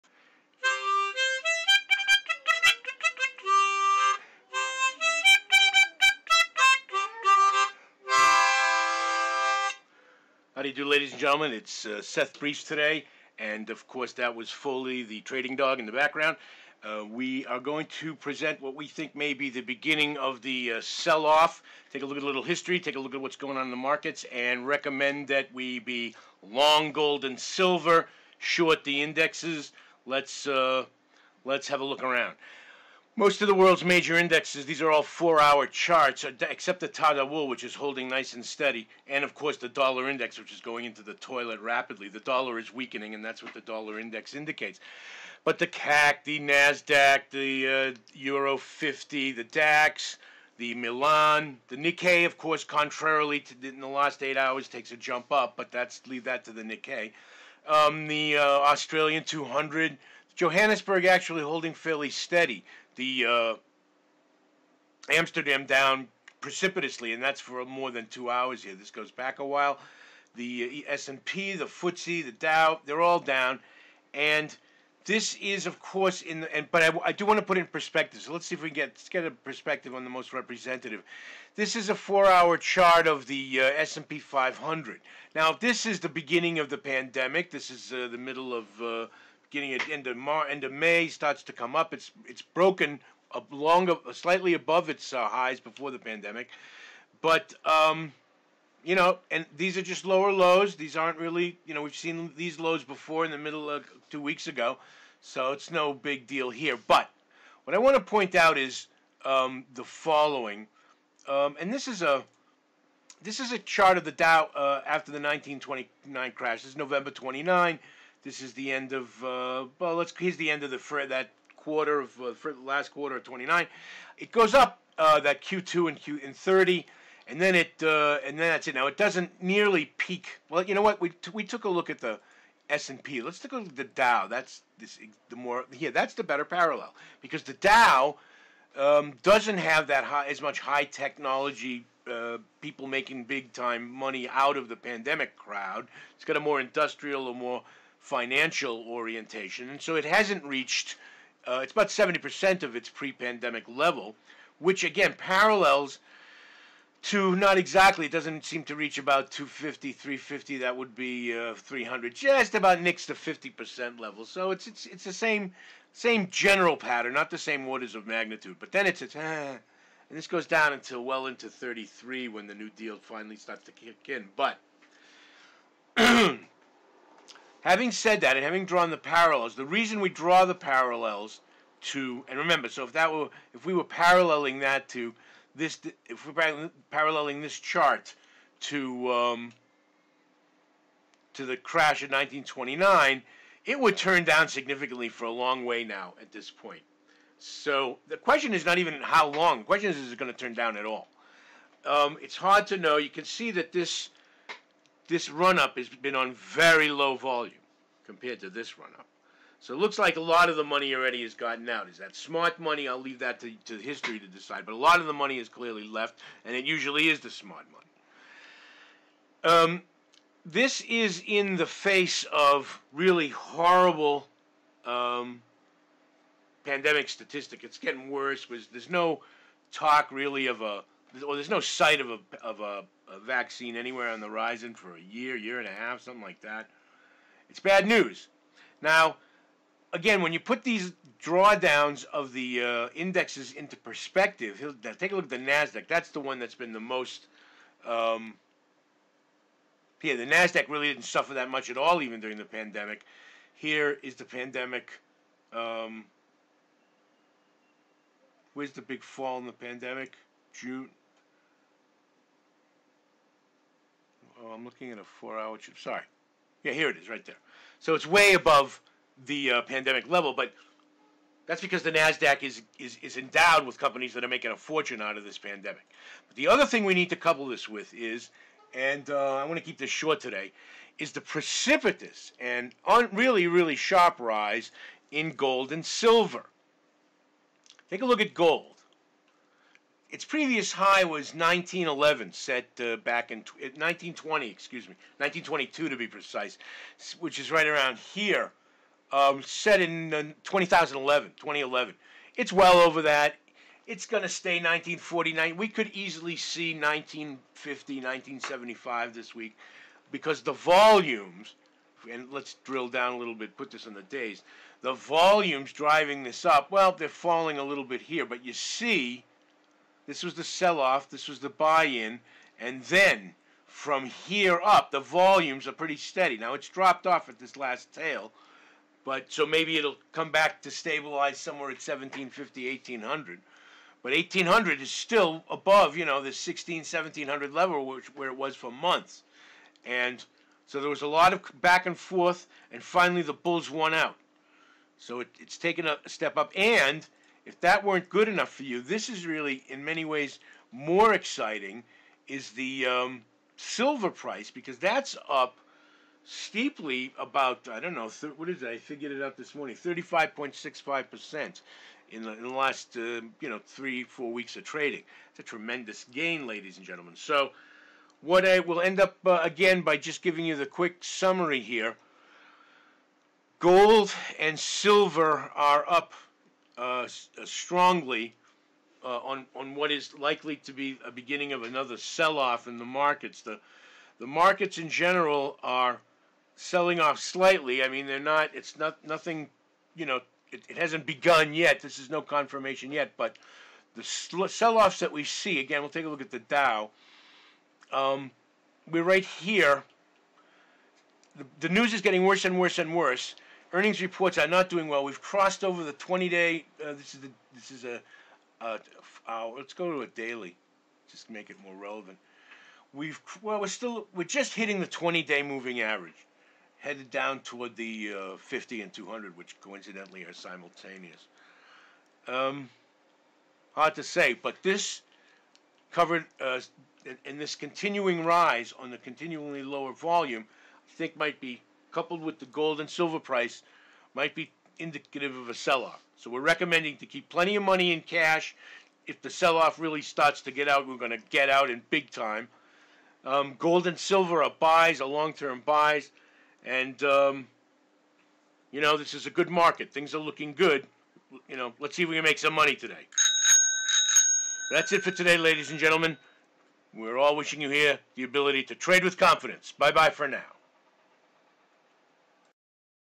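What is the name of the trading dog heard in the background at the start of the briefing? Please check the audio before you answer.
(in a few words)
Foley.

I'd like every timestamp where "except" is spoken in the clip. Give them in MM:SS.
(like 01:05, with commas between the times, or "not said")
00:36.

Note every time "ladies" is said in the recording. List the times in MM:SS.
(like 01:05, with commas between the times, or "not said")
00:10, 06:06, 07:35.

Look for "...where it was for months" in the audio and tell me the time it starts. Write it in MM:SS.
05:38.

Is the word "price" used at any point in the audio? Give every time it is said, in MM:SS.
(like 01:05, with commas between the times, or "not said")
05:54, 07:13.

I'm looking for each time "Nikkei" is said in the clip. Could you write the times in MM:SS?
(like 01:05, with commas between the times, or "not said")
00:51, 00:56.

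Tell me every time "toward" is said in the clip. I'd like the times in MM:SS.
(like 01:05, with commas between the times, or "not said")
06:57.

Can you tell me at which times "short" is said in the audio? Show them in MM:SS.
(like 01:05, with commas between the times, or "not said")
00:28, 04:39.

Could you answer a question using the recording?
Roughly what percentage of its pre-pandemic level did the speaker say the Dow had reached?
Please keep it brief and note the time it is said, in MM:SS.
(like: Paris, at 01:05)
70%, at 02:31.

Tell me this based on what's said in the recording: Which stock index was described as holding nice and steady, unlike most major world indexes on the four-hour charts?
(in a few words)
Tadawul.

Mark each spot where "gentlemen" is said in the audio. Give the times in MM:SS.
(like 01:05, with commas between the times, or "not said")
00:11, 06:06, 07:35.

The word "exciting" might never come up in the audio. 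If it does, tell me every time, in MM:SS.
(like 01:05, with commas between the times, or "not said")
05:51.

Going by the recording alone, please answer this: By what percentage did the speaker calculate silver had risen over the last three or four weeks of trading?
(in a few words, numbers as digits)
35.65%.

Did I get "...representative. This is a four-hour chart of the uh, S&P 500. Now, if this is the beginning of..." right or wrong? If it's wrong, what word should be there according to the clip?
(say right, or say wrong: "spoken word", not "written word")
right.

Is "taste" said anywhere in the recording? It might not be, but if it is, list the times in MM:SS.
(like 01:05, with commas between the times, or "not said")
not said.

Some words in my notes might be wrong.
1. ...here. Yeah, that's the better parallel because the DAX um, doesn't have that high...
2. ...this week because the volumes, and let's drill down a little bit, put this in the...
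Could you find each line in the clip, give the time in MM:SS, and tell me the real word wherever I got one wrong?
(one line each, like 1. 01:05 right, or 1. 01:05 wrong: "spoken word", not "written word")
1. 02:15 wrong: "Dow", not "DAX"
2. 05:09 right.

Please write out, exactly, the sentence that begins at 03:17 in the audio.
So the question is not even how long.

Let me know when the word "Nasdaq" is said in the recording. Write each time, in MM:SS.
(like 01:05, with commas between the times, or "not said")
00:46, 04:05, 04:10, 04:31.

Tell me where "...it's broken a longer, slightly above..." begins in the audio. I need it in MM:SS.
01:32.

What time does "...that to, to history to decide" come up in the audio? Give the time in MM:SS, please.
03:33.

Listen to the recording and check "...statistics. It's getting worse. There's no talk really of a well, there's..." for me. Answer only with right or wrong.
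right.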